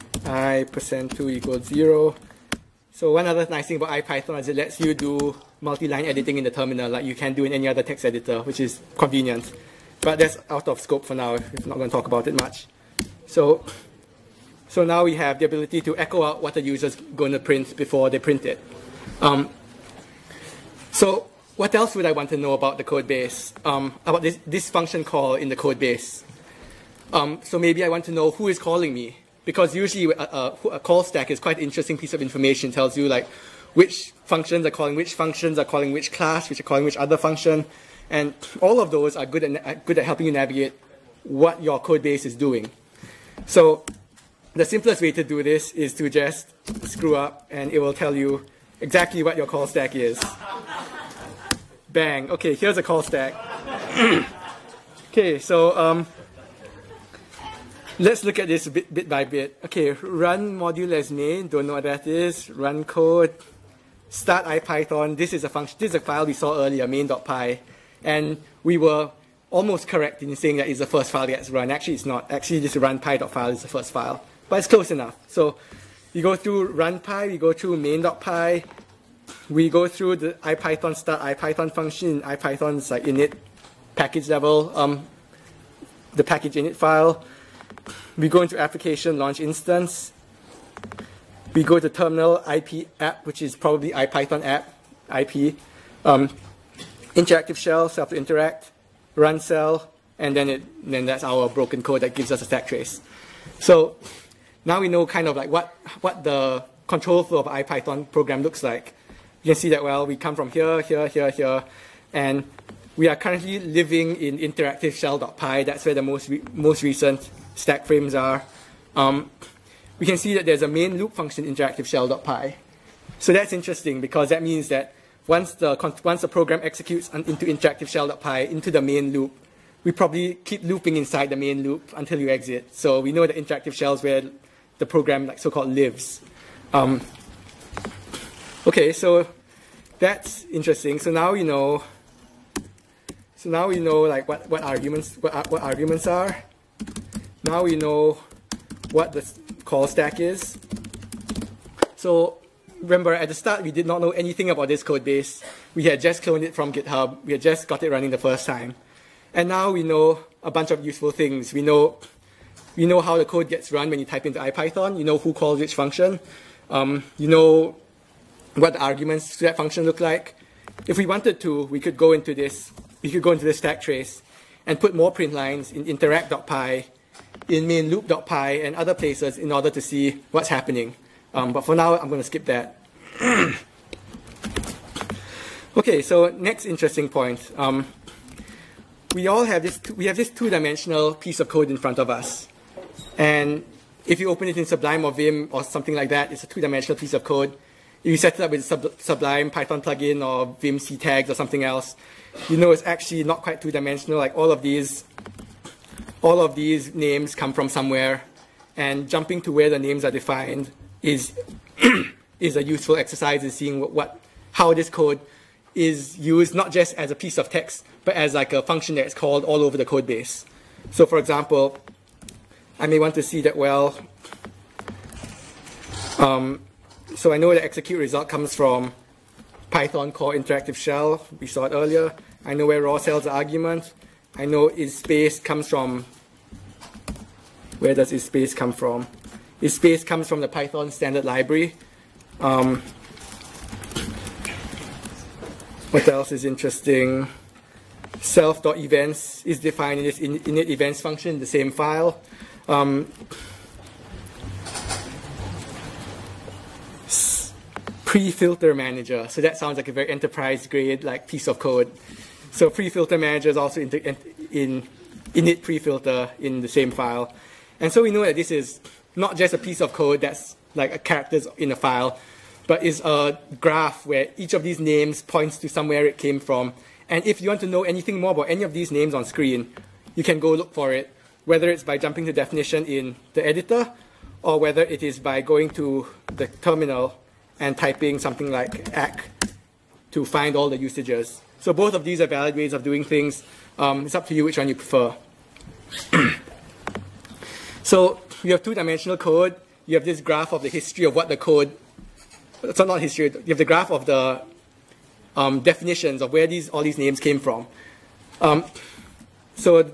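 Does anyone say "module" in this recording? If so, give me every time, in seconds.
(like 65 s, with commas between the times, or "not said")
60 s.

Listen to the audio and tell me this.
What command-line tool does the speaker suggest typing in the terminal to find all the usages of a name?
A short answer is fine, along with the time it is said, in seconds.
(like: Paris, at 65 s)
ack, at 288 s.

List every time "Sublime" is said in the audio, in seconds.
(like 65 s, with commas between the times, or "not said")
194 s, 199 s.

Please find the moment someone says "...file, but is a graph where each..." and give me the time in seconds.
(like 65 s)
271 s.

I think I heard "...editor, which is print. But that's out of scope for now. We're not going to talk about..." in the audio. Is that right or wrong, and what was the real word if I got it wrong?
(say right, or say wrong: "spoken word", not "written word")
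wrong: "convenient", not "print".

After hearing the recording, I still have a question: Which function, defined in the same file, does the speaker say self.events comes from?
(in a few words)
init events.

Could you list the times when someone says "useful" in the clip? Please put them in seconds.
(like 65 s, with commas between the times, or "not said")
160 s, 212 s.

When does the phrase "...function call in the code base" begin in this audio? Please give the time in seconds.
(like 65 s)
24 s.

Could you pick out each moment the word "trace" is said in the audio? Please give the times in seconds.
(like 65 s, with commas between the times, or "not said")
102 s, 173 s.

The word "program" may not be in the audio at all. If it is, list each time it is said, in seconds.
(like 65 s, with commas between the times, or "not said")
108 s, 126 s, 134 s.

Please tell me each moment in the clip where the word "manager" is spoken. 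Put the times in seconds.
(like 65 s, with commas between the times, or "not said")
258 s, 263 s.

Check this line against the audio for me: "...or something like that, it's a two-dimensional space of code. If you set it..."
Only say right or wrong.
wrong.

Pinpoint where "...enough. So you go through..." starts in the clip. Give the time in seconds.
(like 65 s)
74 s.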